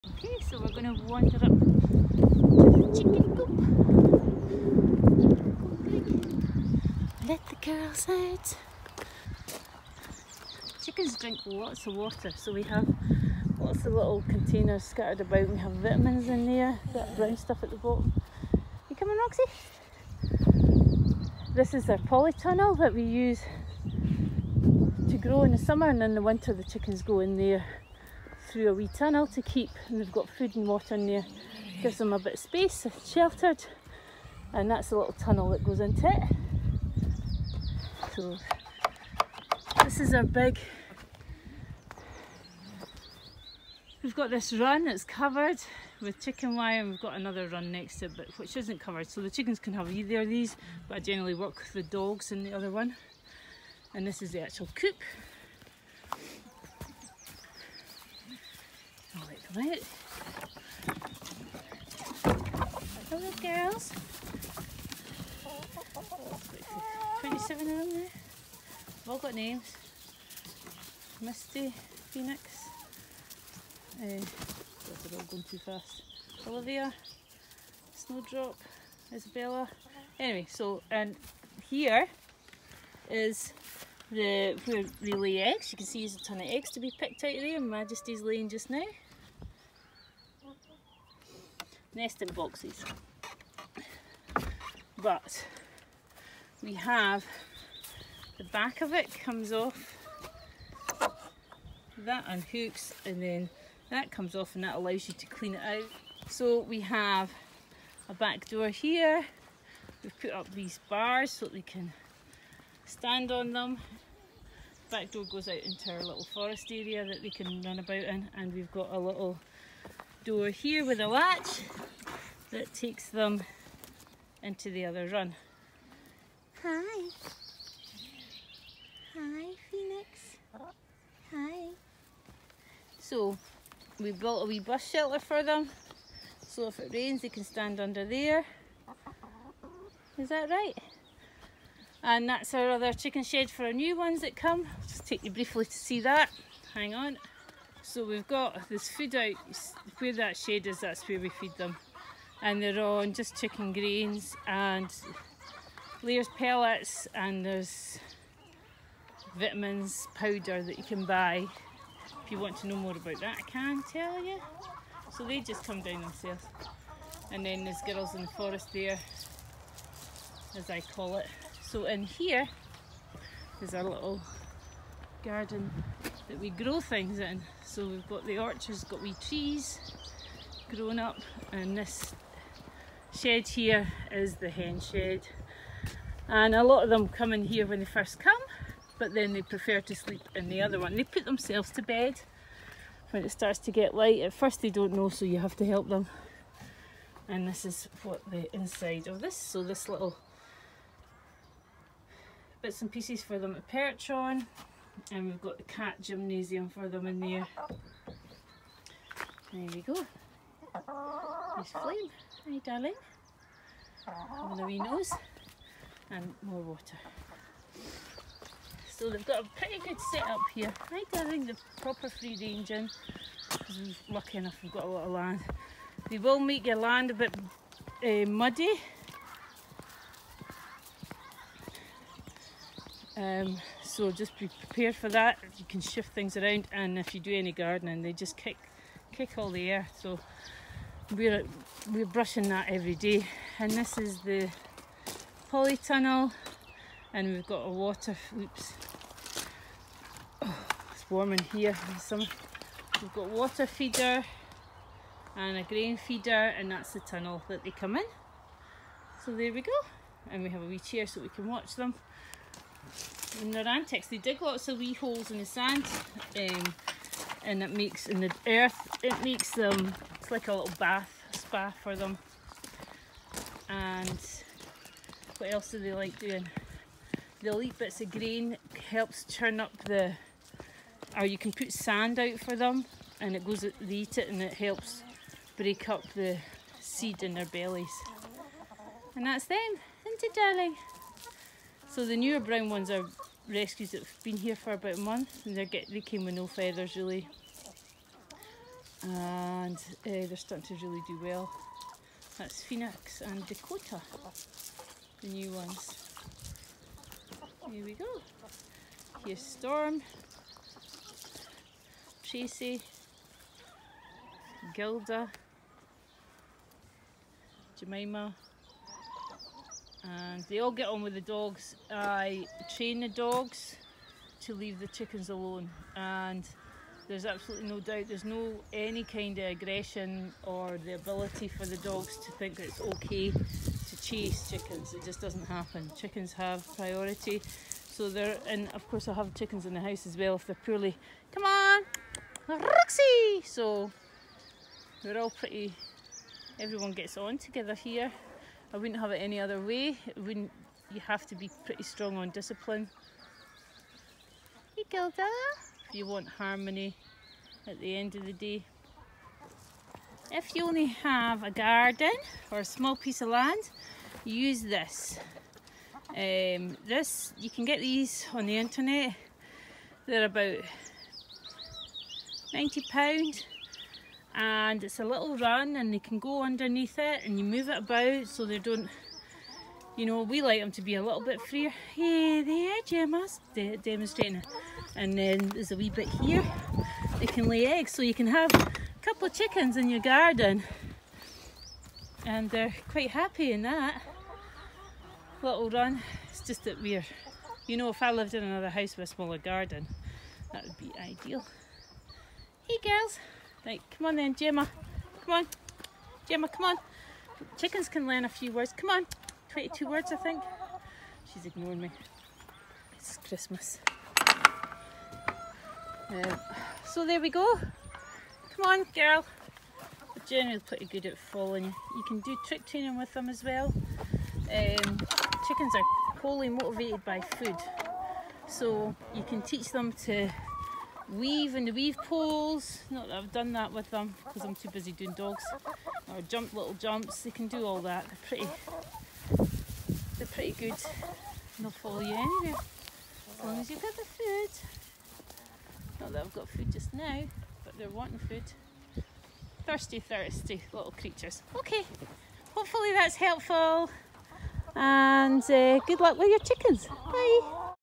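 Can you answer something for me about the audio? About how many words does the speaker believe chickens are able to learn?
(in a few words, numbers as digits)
22.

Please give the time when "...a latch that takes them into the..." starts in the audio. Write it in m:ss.
2:00.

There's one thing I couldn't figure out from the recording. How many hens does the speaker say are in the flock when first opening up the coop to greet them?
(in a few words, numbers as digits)
27.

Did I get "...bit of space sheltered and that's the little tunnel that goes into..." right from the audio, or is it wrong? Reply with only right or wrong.
right.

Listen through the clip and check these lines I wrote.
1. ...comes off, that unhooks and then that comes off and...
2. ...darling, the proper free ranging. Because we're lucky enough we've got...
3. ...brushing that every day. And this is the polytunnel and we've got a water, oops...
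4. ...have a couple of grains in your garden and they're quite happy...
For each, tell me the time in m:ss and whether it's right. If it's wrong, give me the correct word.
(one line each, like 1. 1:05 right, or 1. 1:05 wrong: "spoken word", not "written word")
1. 1:39 right
2. 3:41 right
3. 4:02 right
4. 6:28 wrong: "chickens", not "grains".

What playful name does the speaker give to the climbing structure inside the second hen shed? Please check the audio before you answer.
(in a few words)
Cat gymnasium.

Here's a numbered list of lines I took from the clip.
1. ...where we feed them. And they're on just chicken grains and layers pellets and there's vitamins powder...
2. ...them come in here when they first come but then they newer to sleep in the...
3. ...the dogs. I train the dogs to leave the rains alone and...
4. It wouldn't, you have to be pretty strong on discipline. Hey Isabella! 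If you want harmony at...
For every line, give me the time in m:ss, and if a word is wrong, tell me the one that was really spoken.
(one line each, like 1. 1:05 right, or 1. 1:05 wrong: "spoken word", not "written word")
1. 2:31 right
2. 3:06 wrong: "prefer", not "newer"
3. 5:21 wrong: "chickens", not "rains"
4. 5:50 wrong: "Gilda", not "Isabella".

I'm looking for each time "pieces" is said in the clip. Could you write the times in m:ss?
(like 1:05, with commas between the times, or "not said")
3:22, 6:02.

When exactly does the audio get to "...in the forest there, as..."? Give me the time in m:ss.
2:48.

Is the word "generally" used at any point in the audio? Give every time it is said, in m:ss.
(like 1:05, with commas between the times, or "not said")
0:50, 7:00.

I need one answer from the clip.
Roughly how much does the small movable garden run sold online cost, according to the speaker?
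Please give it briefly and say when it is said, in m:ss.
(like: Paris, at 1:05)
£90, at 6:12.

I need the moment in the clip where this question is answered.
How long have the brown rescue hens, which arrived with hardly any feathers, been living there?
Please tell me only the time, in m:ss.
4:54.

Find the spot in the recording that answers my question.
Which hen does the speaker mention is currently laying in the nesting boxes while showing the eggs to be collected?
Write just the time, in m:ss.
1:27.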